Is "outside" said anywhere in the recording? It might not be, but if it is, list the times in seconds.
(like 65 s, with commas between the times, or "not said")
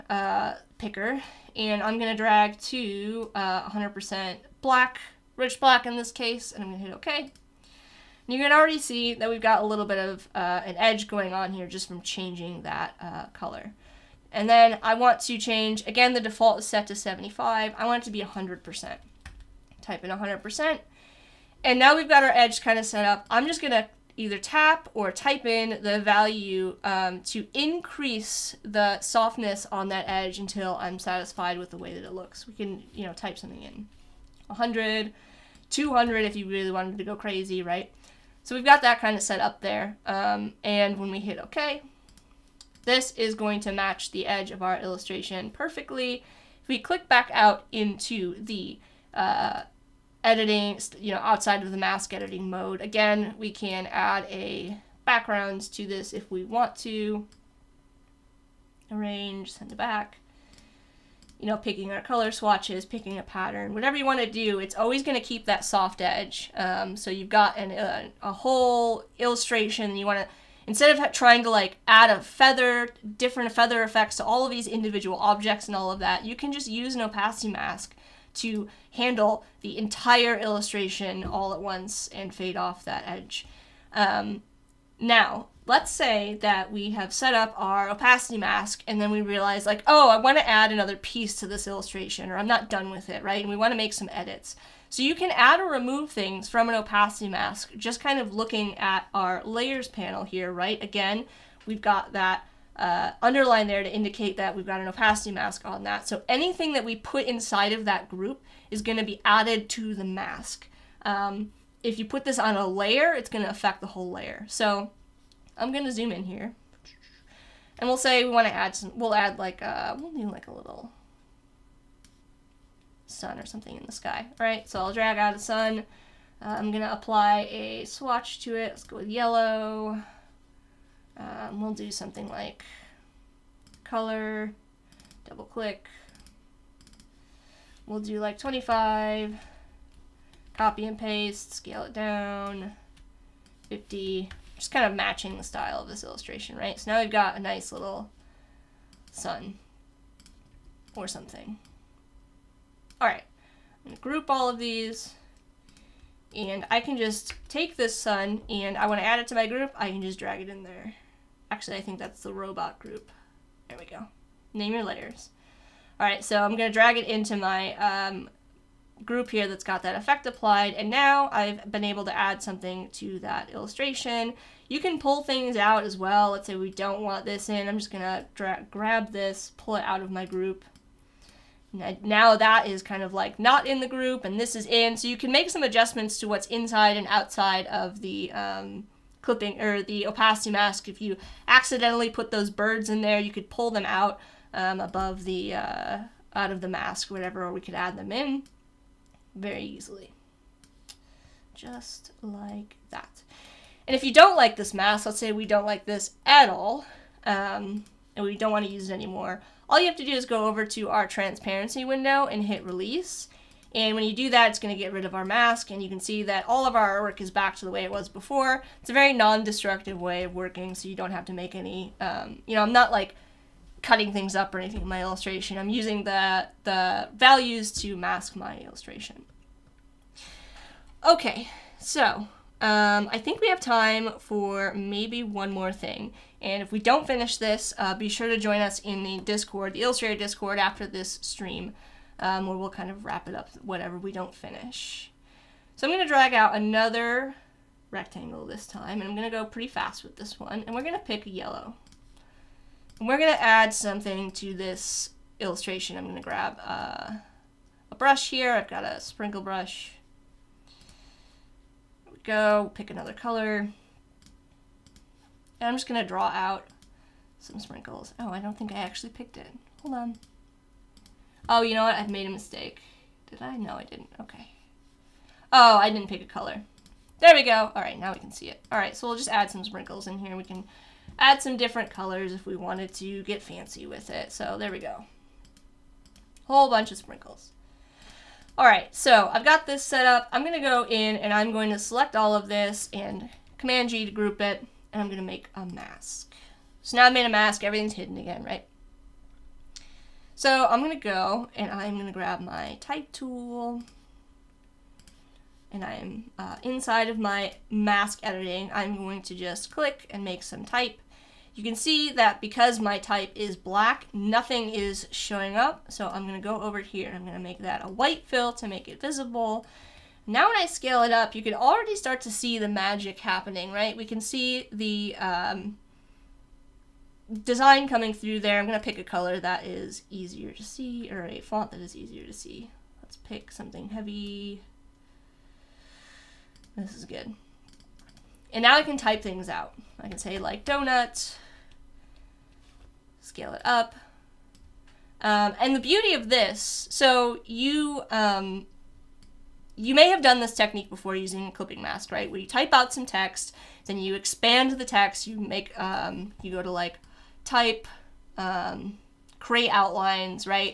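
51 s, 187 s.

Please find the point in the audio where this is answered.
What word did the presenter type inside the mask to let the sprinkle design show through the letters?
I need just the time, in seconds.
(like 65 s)
340 s.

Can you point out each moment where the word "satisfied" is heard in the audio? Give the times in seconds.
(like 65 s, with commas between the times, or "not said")
30 s.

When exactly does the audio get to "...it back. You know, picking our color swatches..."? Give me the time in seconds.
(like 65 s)
59 s.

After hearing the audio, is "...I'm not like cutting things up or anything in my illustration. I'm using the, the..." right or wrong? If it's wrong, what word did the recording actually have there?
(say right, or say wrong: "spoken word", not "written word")
right.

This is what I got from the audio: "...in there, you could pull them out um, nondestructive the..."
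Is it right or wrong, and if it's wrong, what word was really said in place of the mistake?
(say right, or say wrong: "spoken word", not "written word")
wrong: "above", not "nondestructive".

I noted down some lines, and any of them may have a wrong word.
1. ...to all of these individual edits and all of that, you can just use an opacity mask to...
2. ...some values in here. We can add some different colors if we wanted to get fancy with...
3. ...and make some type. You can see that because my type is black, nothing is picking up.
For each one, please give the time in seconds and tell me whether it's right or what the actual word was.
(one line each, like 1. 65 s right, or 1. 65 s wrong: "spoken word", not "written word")
1. 74 s wrong: "objects", not "edits"
2. 279 s wrong: "sprinkles", not "values"
3. 310 s wrong: "showing", not "picking".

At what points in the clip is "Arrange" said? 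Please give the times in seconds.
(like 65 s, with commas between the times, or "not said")
58 s.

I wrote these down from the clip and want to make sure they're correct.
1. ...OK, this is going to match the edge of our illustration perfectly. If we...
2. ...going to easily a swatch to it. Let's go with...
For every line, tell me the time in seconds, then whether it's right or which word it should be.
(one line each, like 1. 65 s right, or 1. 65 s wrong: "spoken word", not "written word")
1. 41 s right
2. 126 s wrong: "apply", not "easily".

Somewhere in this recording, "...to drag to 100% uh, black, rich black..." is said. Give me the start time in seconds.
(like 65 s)
2 s.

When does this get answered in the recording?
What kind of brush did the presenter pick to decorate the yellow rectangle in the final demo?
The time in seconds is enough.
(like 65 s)
258 s.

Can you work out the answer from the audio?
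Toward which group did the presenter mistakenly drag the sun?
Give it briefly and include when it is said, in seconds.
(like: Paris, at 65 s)
The robot group, at 162 s.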